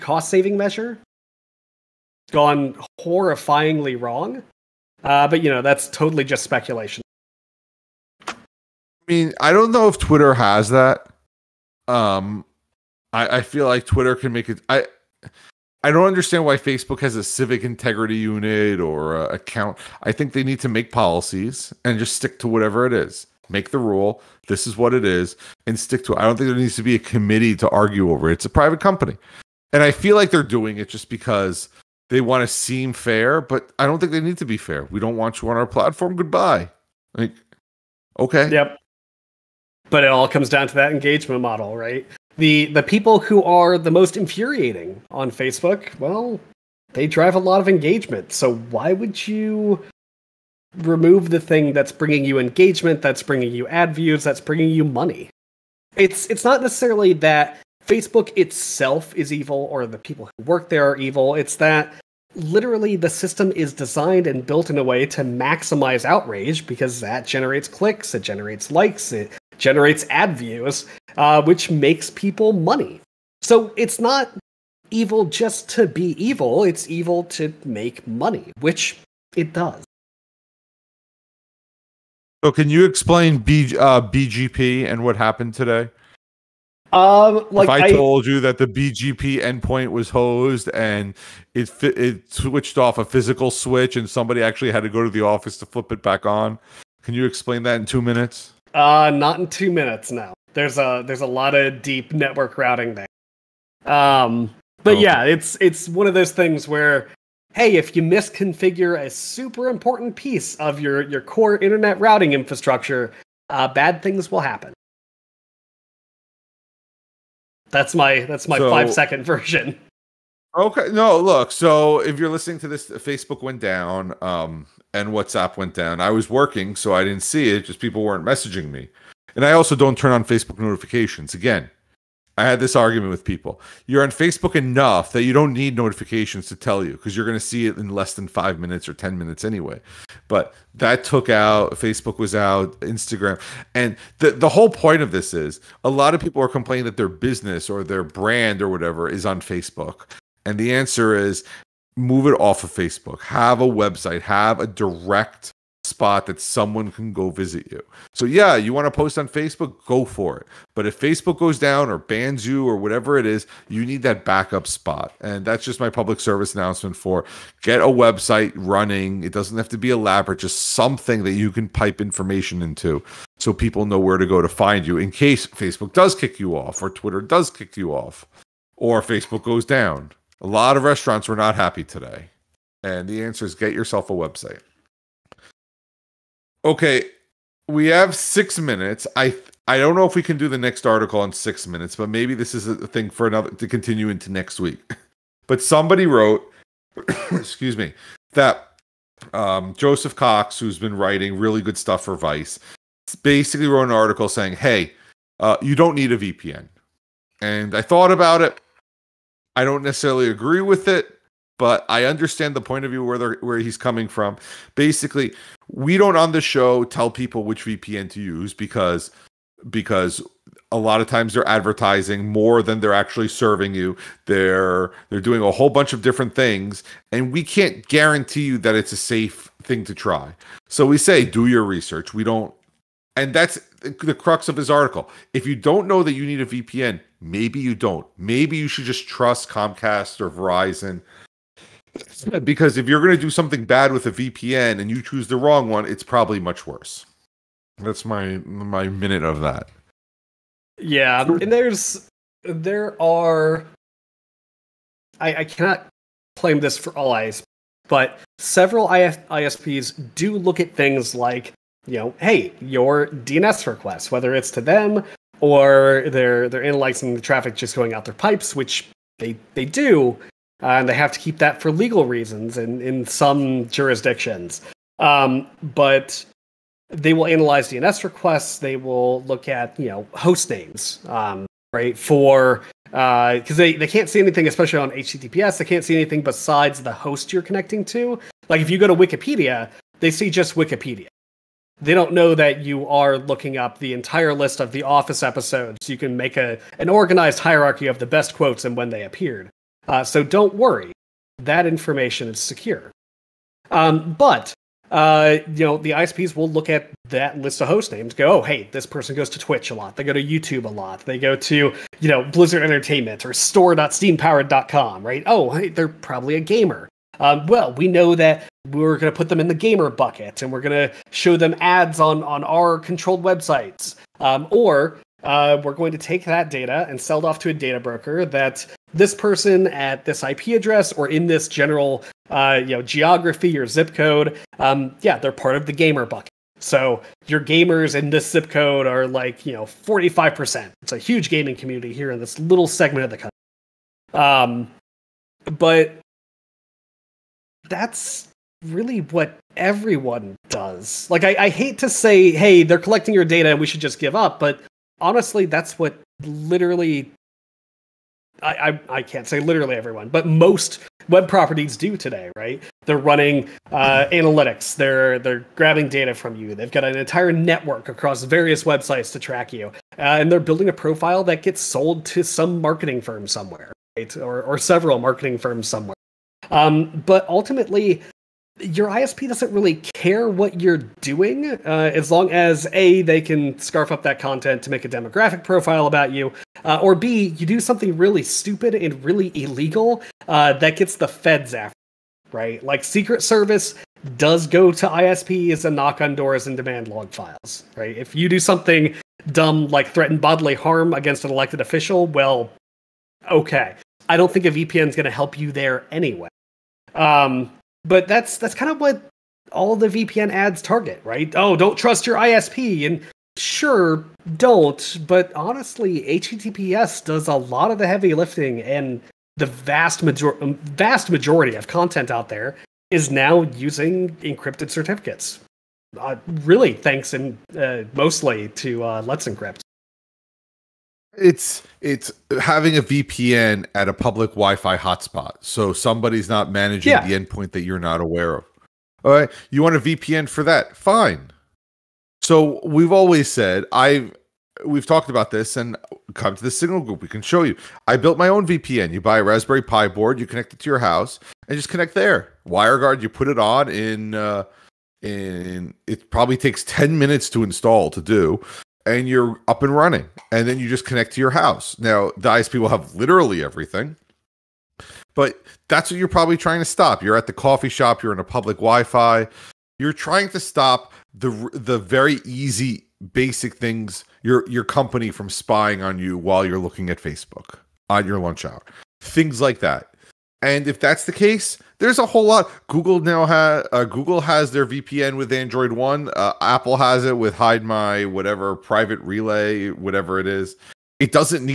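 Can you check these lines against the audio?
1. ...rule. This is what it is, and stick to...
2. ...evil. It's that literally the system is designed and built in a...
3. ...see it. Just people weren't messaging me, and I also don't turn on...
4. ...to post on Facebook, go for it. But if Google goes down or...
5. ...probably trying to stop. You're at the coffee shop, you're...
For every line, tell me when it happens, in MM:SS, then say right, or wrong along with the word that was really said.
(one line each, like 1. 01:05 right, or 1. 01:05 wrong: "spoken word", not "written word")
1. 00:23 right
2. 01:00 right
3. 02:07 right
4. 02:38 wrong: "Facebook", not "Google"
5. 07:46 right.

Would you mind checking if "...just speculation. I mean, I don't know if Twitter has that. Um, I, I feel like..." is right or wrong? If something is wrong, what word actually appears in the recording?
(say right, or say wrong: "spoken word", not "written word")
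right.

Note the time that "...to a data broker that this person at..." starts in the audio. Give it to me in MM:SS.
05:27.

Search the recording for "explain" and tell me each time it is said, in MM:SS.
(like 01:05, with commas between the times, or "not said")
01:22, 01:37.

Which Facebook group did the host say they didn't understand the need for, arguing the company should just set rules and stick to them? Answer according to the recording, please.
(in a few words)
civic integrity unit.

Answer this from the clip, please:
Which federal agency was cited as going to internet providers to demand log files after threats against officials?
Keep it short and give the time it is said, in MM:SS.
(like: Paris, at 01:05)
Secret Service, at 06:32.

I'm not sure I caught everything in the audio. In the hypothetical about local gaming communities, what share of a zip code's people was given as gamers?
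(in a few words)
45%.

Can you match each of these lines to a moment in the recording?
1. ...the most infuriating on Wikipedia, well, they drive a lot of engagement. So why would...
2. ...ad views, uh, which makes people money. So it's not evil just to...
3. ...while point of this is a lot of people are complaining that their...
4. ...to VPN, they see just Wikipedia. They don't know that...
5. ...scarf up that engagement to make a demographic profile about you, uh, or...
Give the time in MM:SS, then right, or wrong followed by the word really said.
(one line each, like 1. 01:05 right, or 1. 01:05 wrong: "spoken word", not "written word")
1. 00:43 wrong: "Facebook", not "Wikipedia"
2. 01:10 right
3. 02:24 wrong: "whole", not "while"
4. 04:48 wrong: "Wikipedia", not "VPN"
5. 06:23 wrong: "content", not "engagement".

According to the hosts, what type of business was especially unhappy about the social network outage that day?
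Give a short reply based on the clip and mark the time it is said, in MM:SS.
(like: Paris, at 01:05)
restaurants, at 03:00.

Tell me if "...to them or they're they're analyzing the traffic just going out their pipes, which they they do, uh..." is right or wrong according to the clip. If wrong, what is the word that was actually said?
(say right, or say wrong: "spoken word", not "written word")
right.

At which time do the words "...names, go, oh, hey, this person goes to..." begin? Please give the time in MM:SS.
05:07.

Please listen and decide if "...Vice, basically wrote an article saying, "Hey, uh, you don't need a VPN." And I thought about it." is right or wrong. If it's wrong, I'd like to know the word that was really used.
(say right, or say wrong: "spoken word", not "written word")
right.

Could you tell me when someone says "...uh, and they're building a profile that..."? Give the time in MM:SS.
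06:09.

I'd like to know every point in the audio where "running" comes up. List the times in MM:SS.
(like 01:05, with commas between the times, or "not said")
02:48, 06:02, 07:39.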